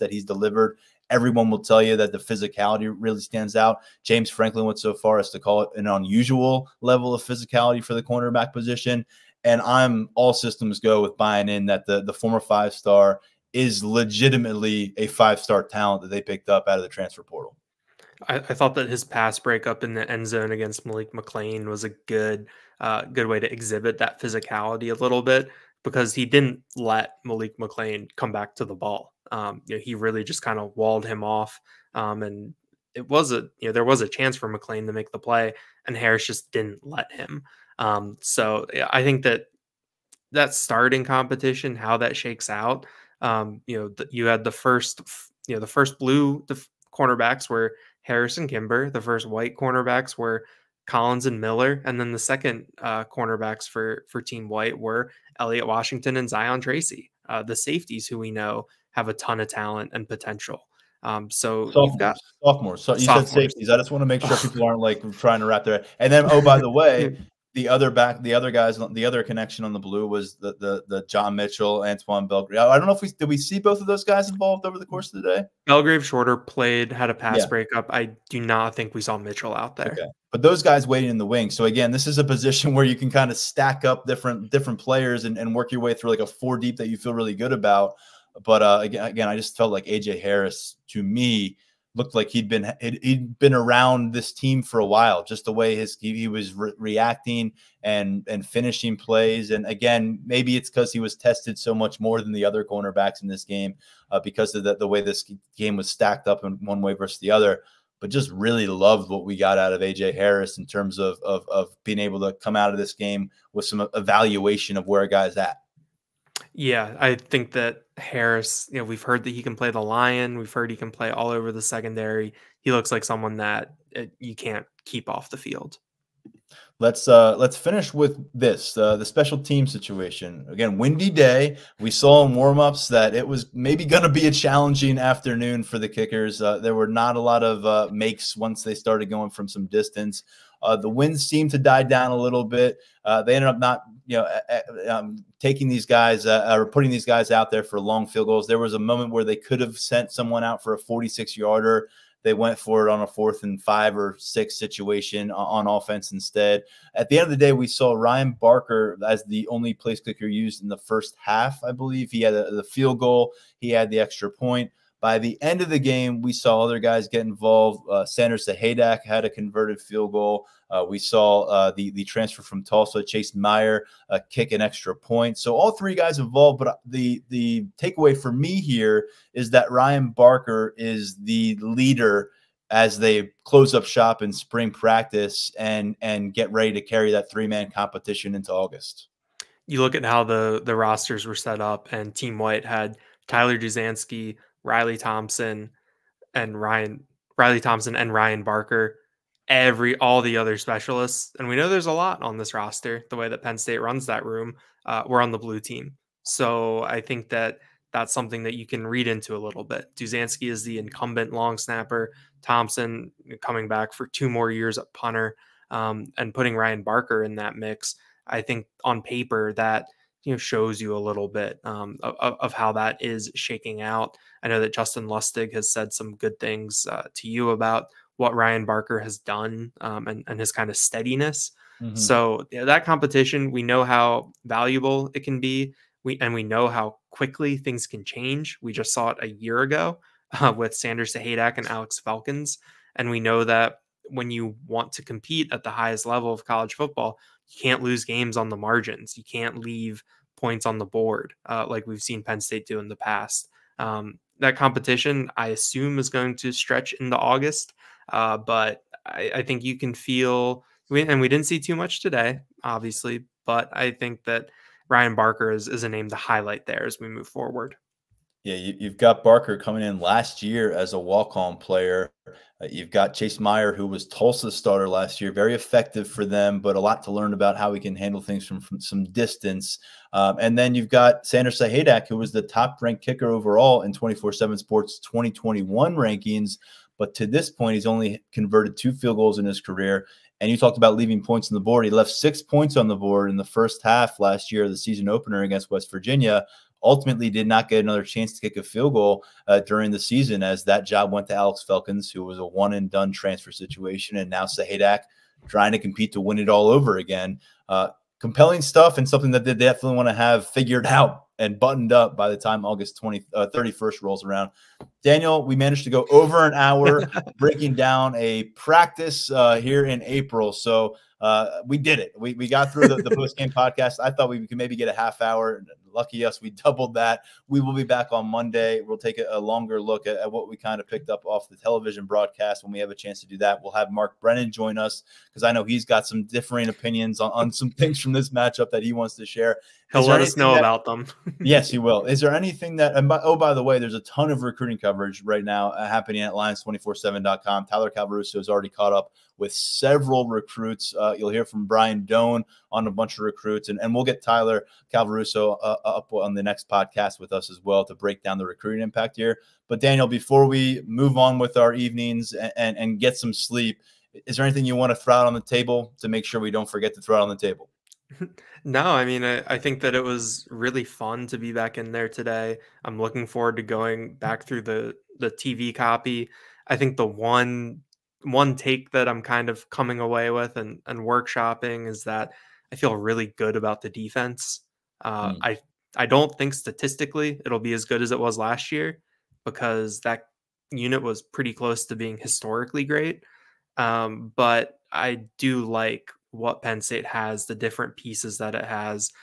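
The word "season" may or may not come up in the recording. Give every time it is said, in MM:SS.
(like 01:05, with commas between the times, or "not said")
04:54, 04:59.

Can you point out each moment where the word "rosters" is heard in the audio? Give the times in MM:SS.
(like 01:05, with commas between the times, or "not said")
03:10, 03:22.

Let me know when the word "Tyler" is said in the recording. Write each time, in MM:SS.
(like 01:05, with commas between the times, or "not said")
03:13, 05:47, 05:54.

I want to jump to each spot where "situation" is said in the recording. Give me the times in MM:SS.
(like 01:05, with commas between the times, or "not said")
02:09, 02:34, 05:03.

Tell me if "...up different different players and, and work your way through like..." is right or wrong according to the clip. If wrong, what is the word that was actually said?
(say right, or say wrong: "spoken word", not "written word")
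right.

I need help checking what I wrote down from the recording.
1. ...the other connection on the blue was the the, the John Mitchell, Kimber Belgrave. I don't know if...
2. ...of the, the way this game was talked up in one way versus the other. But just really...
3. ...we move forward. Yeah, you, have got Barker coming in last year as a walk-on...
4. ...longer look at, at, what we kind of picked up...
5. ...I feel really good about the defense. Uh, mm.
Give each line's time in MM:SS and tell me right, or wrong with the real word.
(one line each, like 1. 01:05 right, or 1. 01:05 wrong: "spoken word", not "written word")
1. 01:08 wrong: "Antoine", not "Kimber"
2. 01:44 wrong: "stacked", not "talked"
3. 04:26 right
4. 05:29 right
5. 06:22 right.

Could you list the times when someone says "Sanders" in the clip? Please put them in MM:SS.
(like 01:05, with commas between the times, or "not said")
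02:48, 04:00, 04:41.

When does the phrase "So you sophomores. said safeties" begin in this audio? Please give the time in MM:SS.
01:02.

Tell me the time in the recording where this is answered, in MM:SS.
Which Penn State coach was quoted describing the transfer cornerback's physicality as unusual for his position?
00:04.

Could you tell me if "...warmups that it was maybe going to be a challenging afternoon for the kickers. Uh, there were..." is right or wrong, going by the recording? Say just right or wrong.
right.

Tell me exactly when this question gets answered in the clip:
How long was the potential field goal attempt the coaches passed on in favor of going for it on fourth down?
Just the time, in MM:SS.
02:30.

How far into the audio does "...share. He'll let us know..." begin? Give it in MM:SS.
05:39.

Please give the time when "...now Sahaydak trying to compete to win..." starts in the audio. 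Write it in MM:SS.
05:04.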